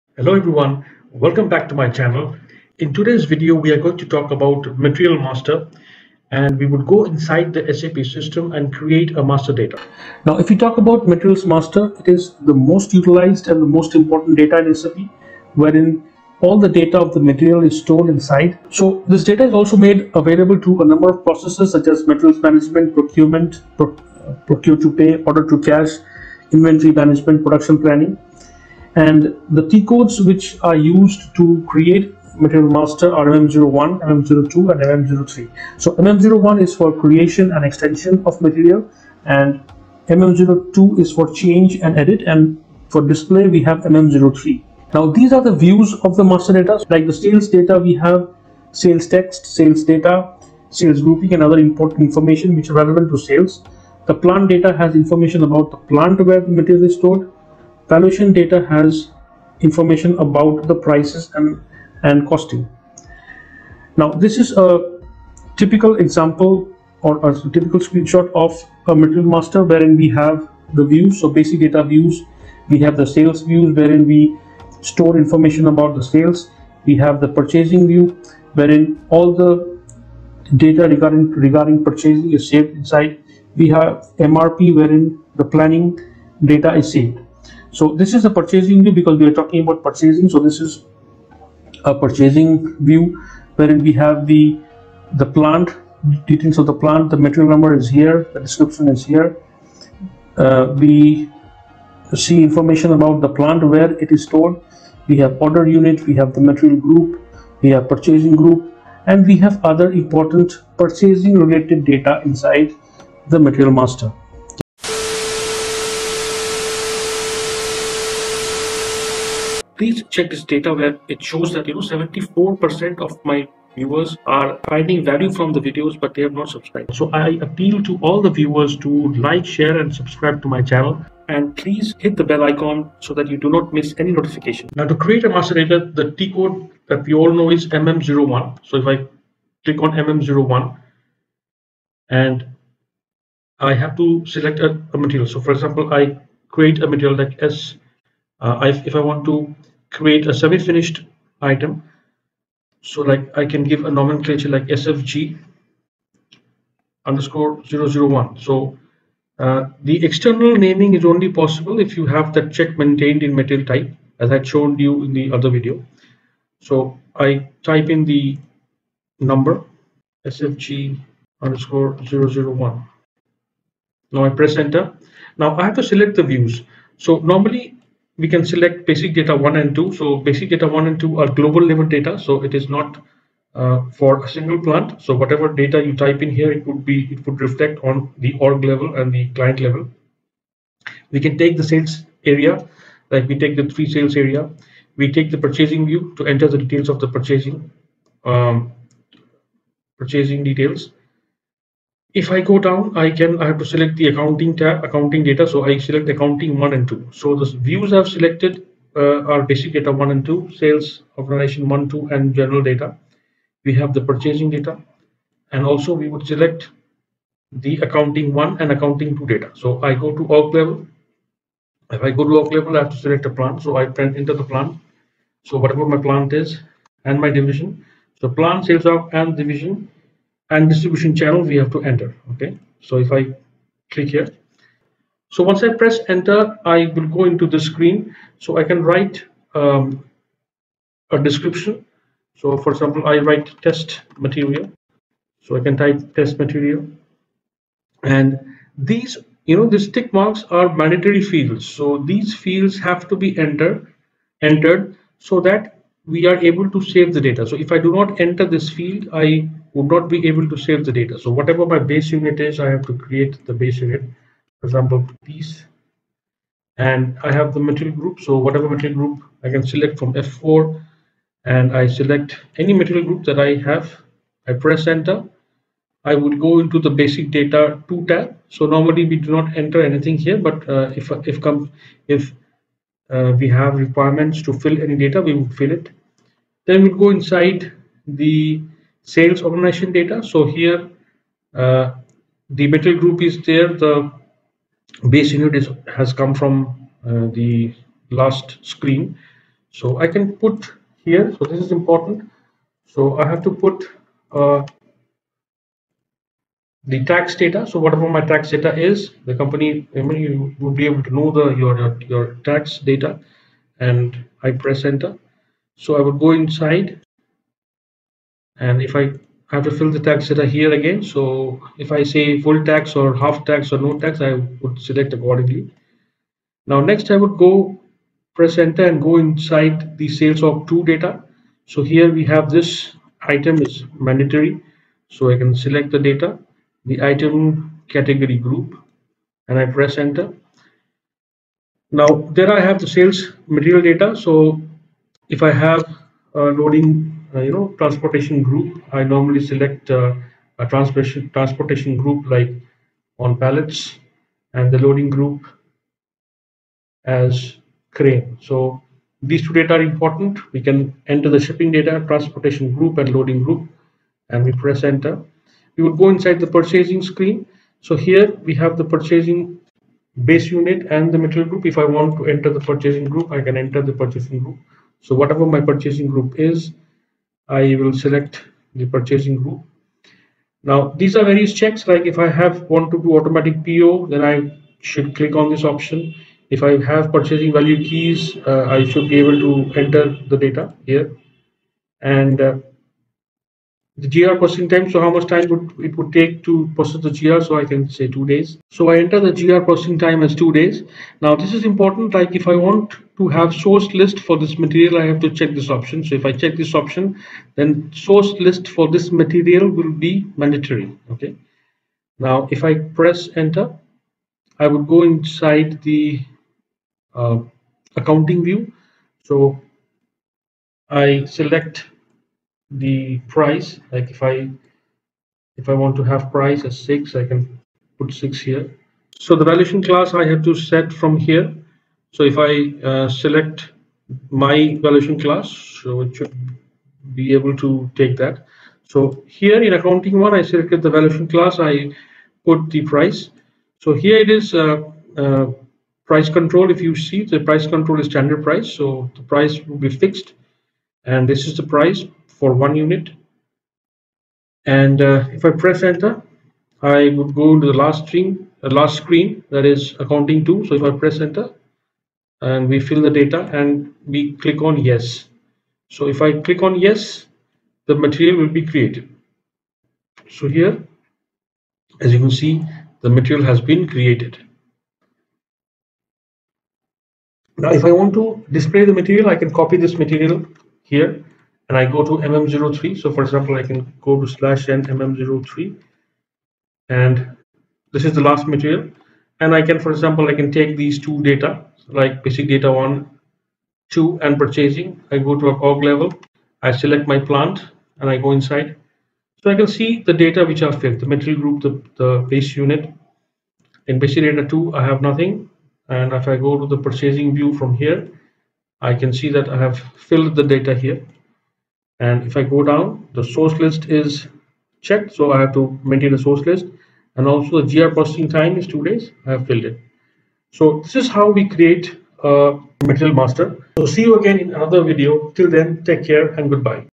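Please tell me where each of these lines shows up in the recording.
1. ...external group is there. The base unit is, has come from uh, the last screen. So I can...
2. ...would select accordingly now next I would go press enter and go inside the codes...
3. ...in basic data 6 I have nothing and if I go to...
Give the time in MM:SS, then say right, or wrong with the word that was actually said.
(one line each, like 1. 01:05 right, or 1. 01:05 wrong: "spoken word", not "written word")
1. 04:52 wrong: "metal", not "external"
2. 05:24 wrong: "sales", not "codes"
3. 08:23 wrong: "2", not "6".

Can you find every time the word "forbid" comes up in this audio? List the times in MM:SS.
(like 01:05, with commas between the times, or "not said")
not said.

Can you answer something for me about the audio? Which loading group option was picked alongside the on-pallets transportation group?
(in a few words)
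crane.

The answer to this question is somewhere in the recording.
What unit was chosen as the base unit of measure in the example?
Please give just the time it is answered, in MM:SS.
04:25.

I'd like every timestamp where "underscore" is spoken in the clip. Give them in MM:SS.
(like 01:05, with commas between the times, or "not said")
02:37, 02:51.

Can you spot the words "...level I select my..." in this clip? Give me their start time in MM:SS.
08:15.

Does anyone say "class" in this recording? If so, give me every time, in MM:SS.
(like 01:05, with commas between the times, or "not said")
07:09, 07:15, 07:21.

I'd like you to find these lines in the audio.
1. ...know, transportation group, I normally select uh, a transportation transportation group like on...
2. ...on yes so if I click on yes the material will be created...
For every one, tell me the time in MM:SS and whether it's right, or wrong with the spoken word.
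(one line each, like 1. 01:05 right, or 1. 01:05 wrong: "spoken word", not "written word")
1. 05:47 right
2. 07:44 right.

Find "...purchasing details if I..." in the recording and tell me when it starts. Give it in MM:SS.
03:19.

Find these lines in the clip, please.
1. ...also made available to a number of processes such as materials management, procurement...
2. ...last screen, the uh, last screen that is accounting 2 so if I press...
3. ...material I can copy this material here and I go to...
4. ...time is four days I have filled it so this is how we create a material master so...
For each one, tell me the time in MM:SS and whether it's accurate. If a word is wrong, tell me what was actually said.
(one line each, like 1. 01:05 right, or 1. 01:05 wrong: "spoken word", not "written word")
1. 00:19 right
2. 07:37 right
3. 07:59 right
4. 08:38 wrong: "two", not "four".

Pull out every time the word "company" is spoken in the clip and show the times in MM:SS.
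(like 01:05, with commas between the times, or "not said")
05:09.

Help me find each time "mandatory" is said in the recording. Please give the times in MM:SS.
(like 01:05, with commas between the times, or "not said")
04:10, 05:33, 06:50.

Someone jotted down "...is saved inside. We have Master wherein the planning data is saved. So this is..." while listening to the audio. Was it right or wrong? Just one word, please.
wrong.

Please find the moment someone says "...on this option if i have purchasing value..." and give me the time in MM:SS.
06:25.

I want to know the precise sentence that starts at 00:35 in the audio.
So MM01 is for creation and extension of material and MM02 is for change and edit and for display we have MM03.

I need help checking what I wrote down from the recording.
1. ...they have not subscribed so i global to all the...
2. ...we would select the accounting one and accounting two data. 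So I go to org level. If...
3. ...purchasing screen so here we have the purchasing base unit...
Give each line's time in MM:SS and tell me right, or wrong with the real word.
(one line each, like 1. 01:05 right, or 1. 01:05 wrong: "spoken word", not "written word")
1. 02:06 wrong: "appeal", not "global"
2. 03:35 right
3. 06:06 right.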